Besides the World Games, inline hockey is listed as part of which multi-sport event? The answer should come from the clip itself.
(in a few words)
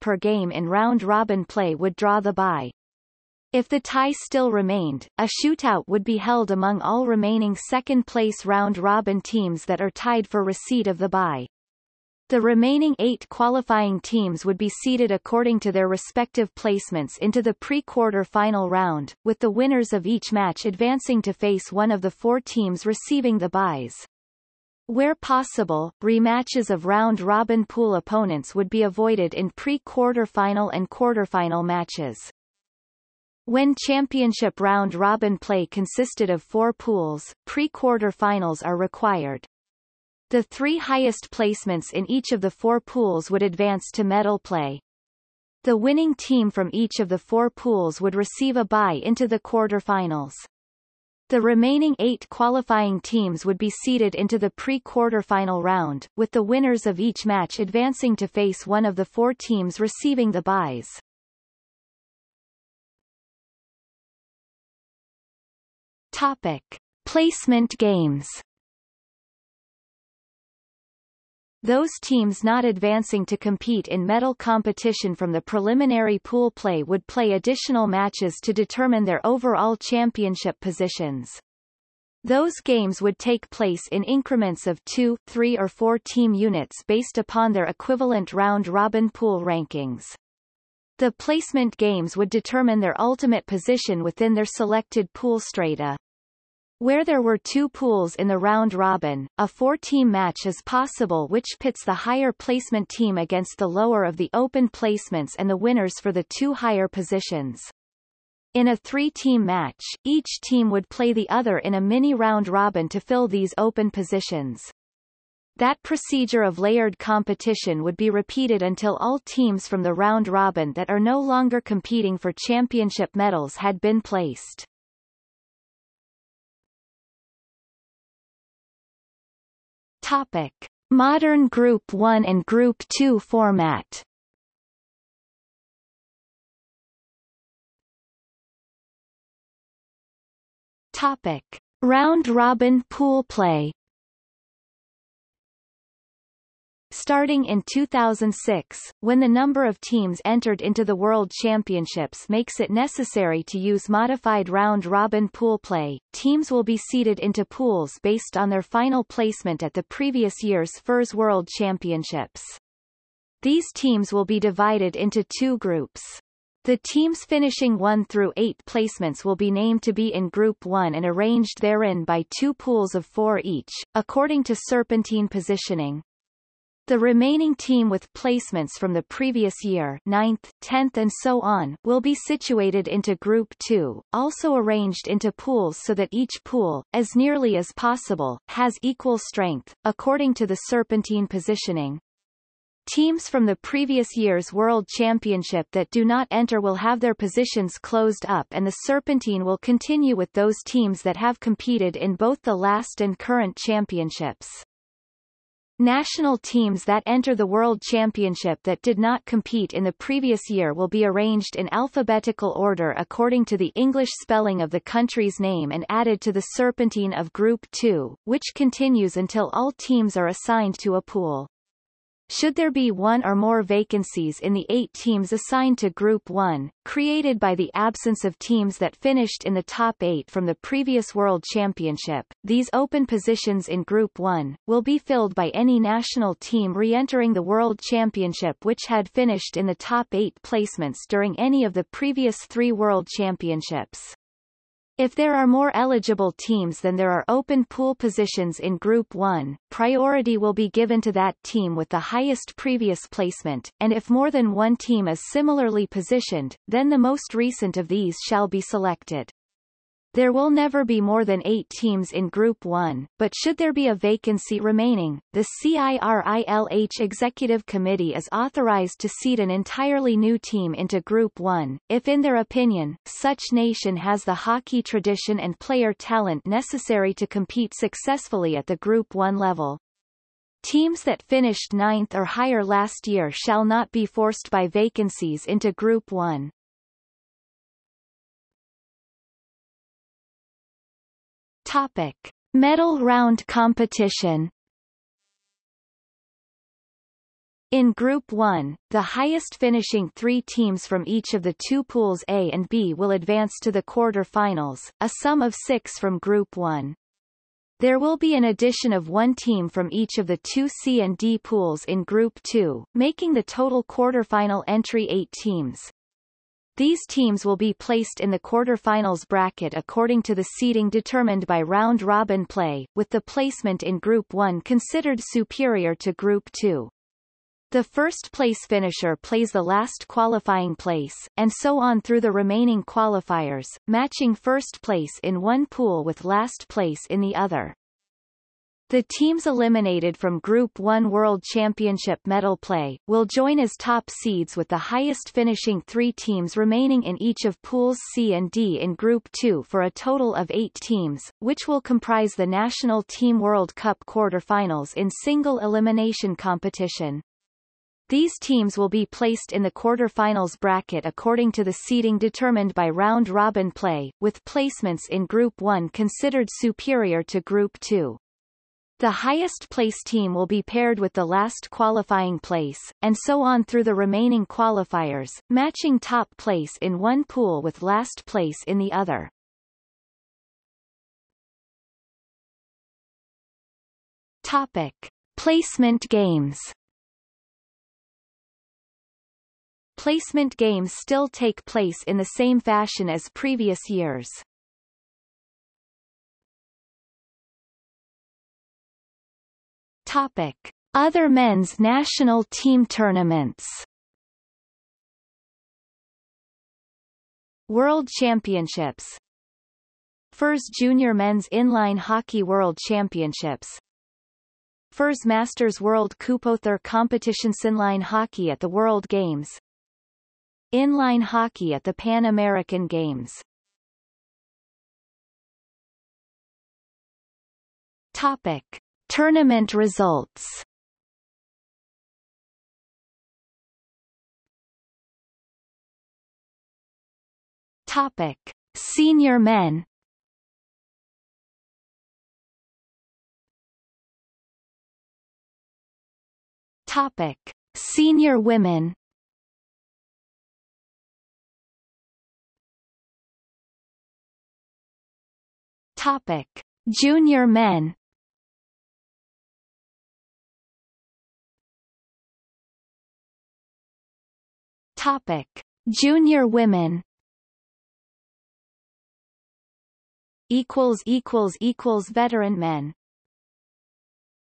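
Pan American Games.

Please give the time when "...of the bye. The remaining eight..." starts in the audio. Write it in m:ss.
0:10.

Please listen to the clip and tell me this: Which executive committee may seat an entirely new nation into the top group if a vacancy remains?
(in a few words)
CIRILH Executive Committee.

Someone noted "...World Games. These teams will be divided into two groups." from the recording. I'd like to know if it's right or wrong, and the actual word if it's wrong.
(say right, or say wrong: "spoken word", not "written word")
wrong: "Championships", not "Games".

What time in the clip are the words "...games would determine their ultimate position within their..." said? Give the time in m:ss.
1:31.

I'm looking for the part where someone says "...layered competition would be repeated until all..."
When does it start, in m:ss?
1:56.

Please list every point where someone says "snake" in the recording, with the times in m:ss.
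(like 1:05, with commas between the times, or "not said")
not said.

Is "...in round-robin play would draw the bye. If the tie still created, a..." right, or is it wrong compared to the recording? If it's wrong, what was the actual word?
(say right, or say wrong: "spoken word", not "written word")
wrong: "remained", not "created".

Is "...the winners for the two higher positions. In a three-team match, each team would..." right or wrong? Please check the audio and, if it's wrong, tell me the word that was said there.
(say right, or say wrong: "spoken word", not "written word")
right.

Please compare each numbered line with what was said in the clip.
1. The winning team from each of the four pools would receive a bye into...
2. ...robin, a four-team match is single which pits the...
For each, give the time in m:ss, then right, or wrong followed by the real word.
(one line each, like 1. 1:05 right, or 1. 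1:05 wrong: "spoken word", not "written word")
1. 0:45 right
2. 1:38 wrong: "possible", not "single".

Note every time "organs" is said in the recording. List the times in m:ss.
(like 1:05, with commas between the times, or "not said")
not said.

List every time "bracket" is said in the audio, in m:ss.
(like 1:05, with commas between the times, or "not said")
5:19, 6:00.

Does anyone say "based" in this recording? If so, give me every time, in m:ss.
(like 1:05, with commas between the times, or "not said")
1:26, 2:38.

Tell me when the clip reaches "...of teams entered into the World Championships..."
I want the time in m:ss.
2:29.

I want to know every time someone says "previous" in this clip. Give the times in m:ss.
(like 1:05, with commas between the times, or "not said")
2:39, 2:59, 3:13, 3:29, 3:50, 4:01, 4:12, 6:33.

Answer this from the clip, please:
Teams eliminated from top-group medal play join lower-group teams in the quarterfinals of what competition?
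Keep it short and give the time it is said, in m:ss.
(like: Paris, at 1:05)
National Team World Cup, at 5:52.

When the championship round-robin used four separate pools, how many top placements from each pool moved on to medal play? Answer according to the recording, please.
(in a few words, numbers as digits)
3.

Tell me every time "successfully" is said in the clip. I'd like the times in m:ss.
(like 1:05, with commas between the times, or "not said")
4:37.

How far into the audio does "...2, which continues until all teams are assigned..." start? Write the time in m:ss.
3:37.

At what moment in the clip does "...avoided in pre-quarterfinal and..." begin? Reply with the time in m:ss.
0:28.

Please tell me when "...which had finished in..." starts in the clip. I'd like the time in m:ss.
3:58.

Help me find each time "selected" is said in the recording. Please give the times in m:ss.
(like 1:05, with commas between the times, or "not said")
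1:34, 4:18.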